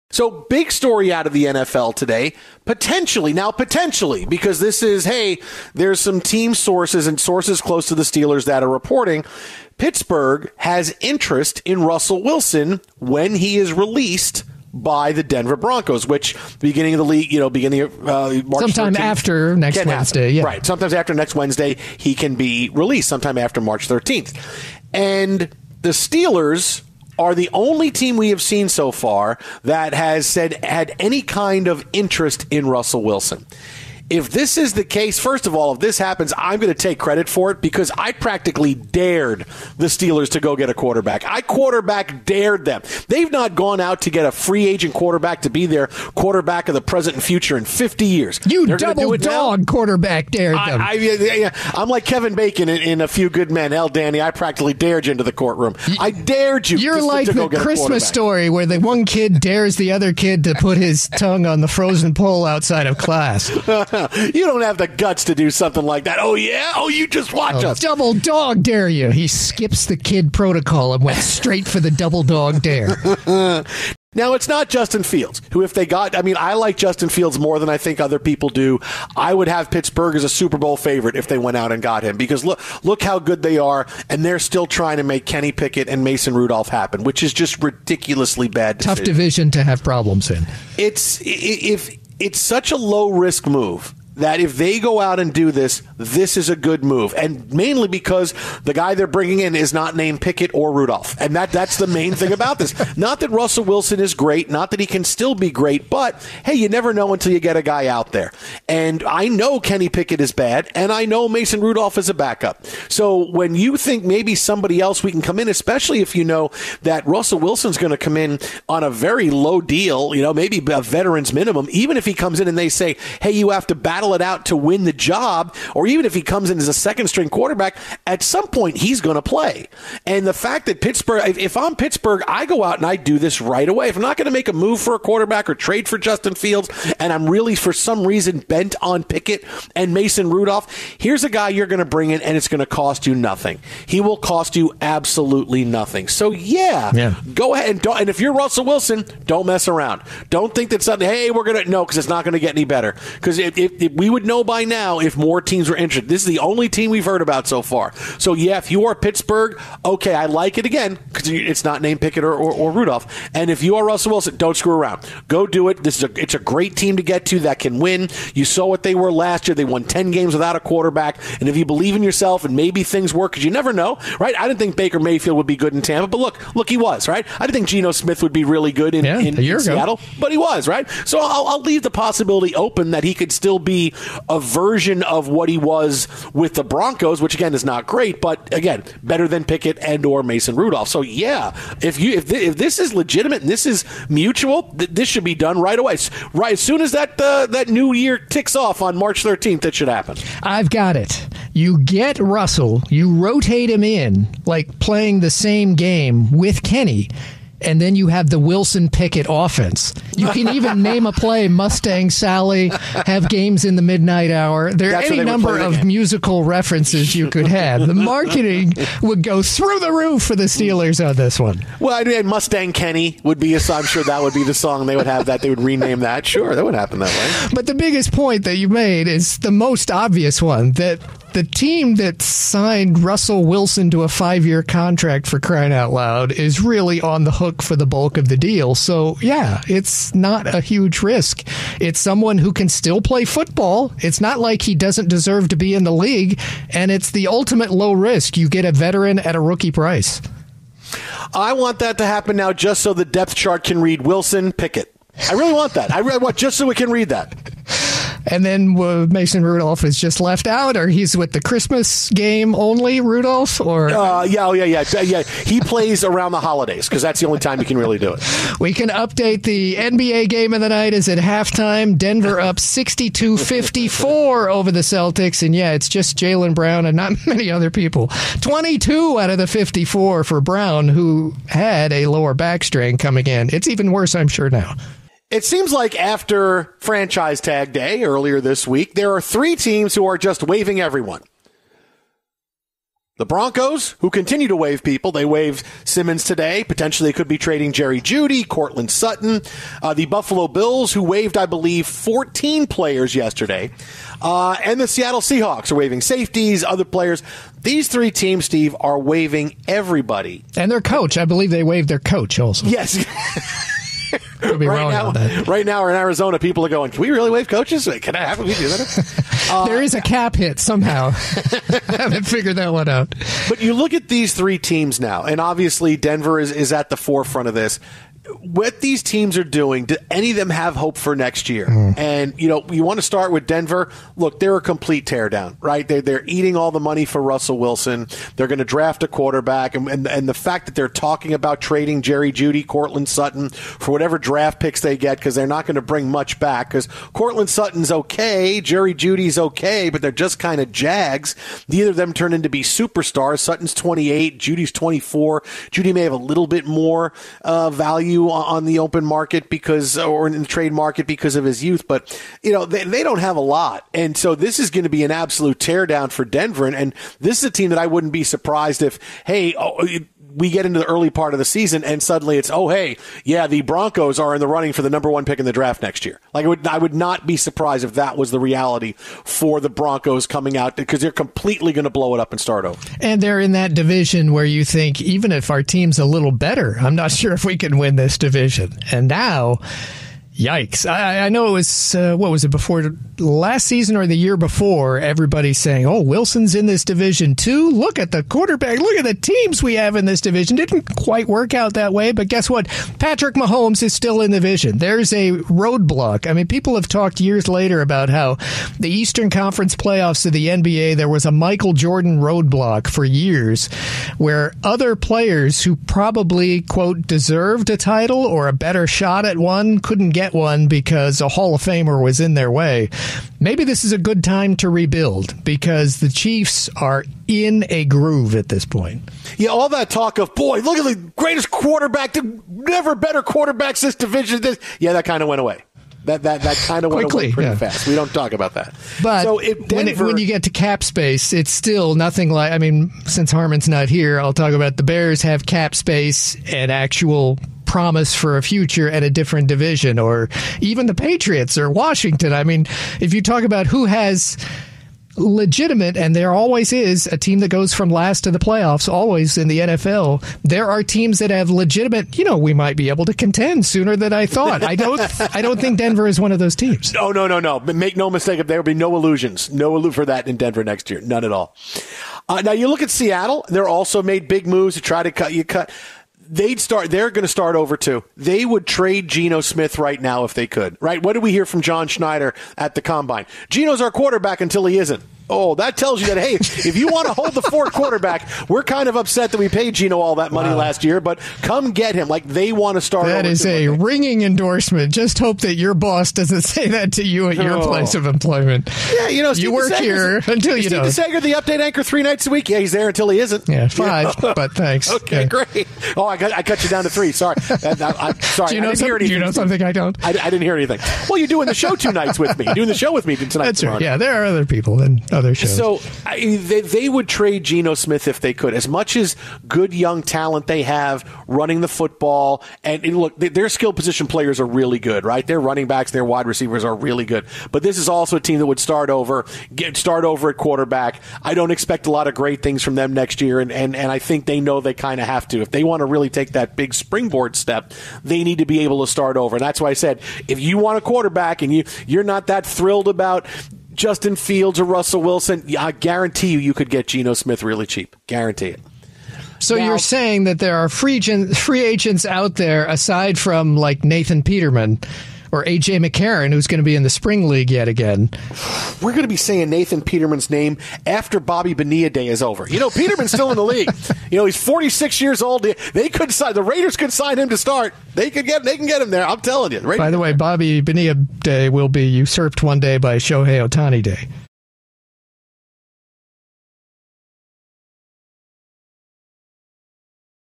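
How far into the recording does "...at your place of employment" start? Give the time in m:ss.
8:17.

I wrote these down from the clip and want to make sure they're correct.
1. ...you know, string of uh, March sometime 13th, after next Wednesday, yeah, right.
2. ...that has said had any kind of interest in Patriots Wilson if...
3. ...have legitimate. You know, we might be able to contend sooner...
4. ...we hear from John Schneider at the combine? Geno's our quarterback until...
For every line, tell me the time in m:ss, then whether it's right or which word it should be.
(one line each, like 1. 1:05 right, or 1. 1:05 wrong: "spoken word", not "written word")
1. 0:17 wrong: "beginning", not "string"
2. 0:29 wrong: "Russell", not "Patriots"
3. 7:41 right
4. 8:01 right.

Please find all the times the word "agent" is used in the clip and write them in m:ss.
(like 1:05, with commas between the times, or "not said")
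0:44, 9:11.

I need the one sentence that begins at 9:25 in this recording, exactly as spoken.
They could sign the Raiders could sign him to start.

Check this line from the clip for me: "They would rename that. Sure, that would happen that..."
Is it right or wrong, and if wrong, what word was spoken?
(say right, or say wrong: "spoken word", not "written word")
right.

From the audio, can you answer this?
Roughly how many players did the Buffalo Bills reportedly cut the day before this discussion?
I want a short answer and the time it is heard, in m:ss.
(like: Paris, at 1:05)
14, at 5:01.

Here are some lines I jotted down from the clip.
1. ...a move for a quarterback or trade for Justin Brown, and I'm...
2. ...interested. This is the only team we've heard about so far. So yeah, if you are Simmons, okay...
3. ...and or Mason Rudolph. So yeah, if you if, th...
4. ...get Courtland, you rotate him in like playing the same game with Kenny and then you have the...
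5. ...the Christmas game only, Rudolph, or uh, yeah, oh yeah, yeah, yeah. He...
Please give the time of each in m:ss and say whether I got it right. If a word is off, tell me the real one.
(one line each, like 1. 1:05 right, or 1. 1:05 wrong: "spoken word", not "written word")
1. 2:14 wrong: "Fields", not "Brown"
2. 2:35 wrong: "Pittsburgh", not "Simmons"
3. 3:09 right
4. 3:21 wrong: "Russell", not "Courtland"
5. 4:21 right.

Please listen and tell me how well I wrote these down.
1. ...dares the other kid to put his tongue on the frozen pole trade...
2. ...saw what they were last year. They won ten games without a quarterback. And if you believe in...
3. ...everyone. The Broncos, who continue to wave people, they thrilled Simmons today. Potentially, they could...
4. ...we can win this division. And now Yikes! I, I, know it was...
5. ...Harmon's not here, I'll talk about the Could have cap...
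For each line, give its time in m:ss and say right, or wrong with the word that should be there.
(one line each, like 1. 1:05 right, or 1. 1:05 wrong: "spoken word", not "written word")
1. 0:59 wrong: "outside", not "trade"
2. 2:48 right
3. 4:50 wrong: "waved", not "thrilled"
4. 6:27 right
5. 7:23 wrong: "Bears", not "Could".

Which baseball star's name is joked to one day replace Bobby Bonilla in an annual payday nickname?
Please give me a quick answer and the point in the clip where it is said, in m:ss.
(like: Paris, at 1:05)
Shohei Ohtani, at 9:32.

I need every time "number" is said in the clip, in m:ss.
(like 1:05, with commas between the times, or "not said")
3:35, 6:14.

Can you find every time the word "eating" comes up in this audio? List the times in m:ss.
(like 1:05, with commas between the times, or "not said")
5:36.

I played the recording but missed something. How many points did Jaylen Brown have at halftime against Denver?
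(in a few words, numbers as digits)
22.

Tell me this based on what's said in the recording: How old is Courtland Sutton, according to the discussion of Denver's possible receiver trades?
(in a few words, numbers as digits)
28.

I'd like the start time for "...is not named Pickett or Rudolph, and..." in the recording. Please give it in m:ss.
1:39.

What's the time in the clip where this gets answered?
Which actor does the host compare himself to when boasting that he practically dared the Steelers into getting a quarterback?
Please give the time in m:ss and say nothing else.
0:52.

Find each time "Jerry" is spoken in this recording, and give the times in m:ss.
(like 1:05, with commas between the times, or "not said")
4:57, 5:42, 5:48.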